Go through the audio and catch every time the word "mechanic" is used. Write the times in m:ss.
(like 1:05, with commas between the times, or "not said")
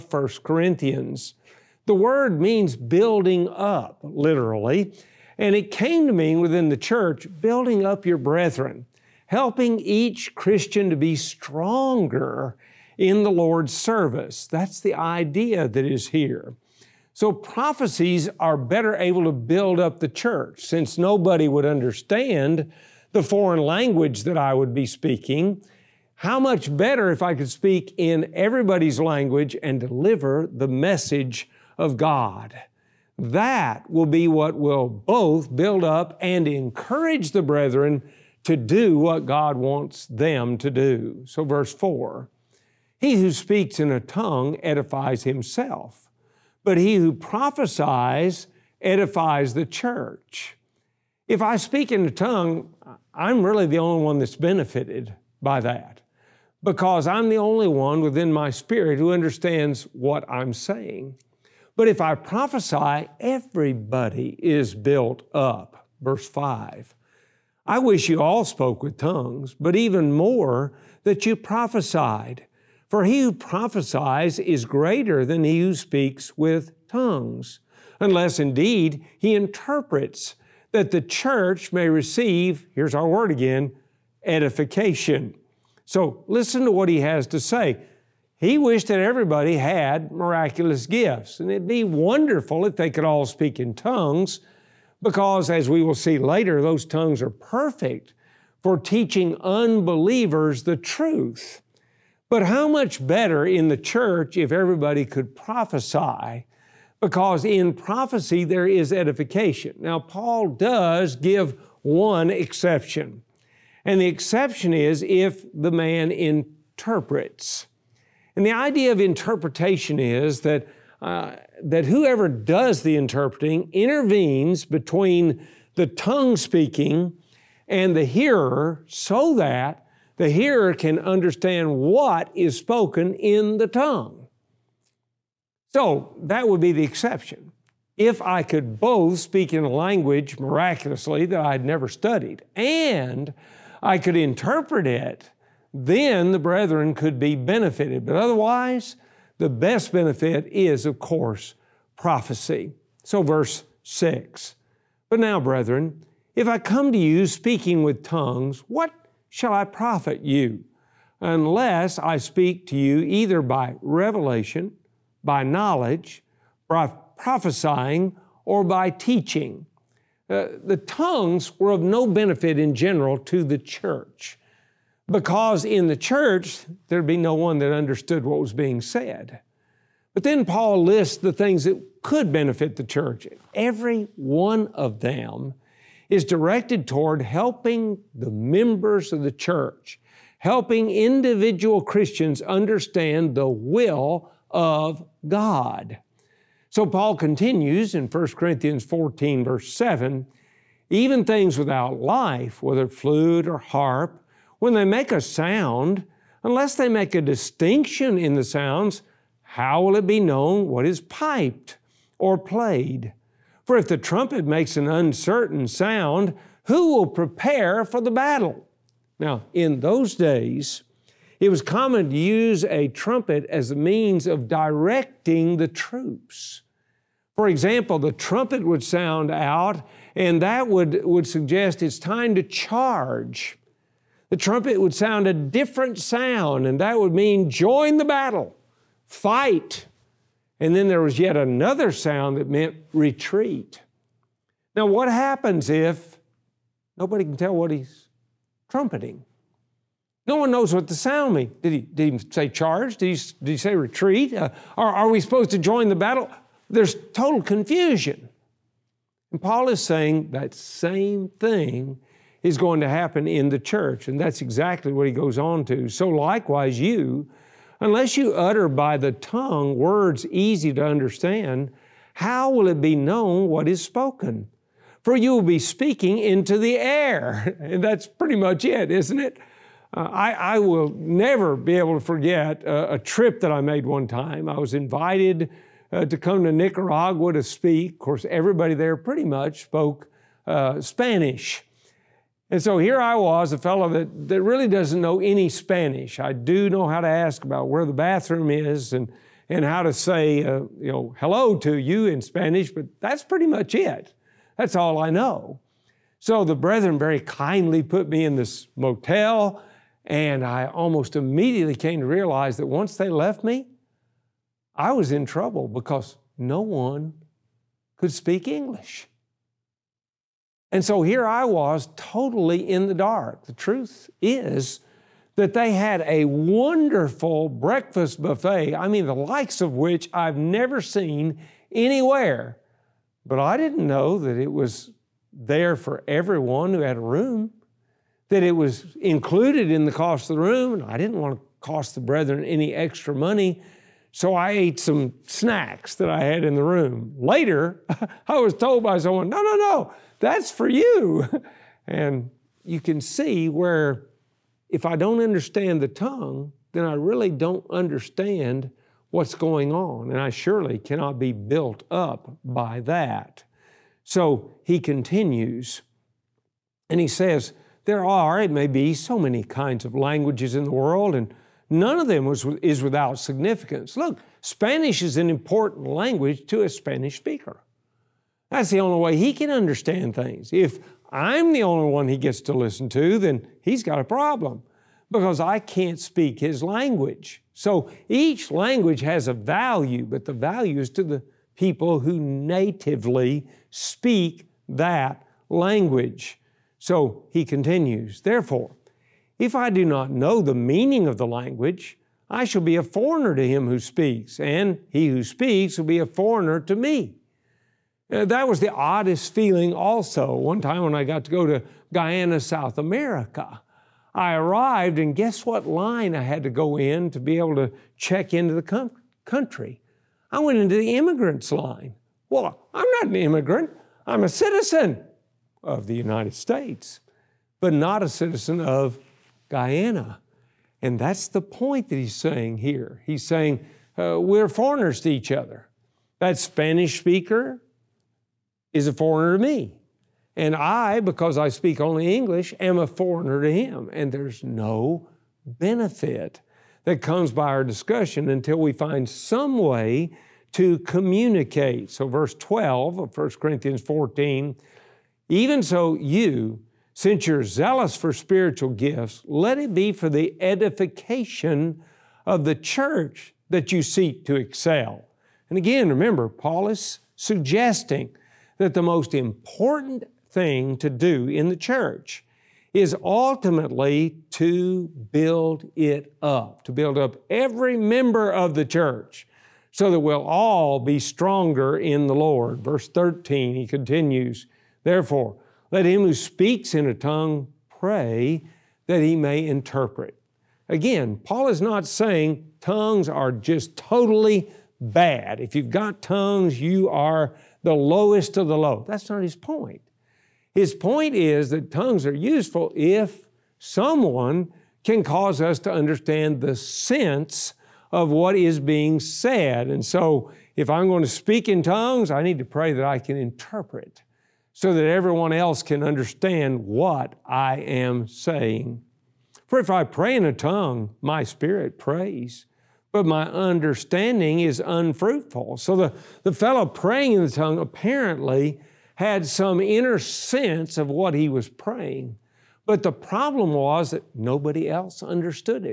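not said.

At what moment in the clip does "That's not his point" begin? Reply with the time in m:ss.
8:18.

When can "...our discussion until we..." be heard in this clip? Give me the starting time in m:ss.
7:27.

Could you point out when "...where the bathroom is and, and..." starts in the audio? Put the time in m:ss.
4:57.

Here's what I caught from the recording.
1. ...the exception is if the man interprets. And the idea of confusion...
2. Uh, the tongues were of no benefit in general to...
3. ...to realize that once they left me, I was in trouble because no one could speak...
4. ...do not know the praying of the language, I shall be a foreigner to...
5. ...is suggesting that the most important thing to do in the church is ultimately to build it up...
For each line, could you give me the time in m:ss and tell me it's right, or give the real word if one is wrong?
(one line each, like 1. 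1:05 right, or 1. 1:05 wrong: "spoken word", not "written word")
1. 1:54 wrong: "interpretation", not "confusion"
2. 2:50 right
3. 5:12 right
4. 6:39 wrong: "meaning", not "praying"
5. 7:46 right.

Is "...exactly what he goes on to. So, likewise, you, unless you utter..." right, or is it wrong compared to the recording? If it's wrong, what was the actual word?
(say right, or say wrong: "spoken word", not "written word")
right.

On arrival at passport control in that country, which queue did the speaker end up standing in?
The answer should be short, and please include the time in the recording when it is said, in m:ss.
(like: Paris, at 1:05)
immigrants line, at 7:00.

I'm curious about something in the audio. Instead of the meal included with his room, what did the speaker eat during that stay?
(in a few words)
some snacks.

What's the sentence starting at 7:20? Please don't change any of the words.
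And I, because I speak only English, am a foreigner to him.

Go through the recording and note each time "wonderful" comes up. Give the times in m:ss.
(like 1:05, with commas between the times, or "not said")
1:31, 5:26.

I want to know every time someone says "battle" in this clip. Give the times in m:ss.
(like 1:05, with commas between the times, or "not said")
3:38, 3:58, 4:15.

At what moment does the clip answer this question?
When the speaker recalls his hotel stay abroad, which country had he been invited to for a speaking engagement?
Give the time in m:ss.
4:46.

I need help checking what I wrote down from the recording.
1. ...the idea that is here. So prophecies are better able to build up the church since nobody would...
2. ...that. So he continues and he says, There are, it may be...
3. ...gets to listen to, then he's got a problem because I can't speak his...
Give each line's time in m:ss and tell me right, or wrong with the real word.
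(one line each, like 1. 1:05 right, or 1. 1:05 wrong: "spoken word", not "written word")
1. 0:14 right
2. 6:02 right
3. 6:22 right.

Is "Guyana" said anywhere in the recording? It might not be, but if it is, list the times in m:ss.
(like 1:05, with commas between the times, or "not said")
6:51, 7:09.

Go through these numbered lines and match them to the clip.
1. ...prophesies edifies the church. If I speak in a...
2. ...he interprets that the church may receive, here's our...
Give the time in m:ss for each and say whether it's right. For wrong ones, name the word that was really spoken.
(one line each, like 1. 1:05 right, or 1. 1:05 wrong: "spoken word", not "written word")
1. 0:47 right
2. 1:19 right.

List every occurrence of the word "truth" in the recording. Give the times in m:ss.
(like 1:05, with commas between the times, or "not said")
1:40, 5:23.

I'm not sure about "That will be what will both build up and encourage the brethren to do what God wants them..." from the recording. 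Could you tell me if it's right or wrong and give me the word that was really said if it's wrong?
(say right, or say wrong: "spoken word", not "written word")
right.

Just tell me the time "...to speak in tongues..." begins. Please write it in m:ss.
8:31.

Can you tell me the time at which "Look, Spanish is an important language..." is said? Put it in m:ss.
6:13.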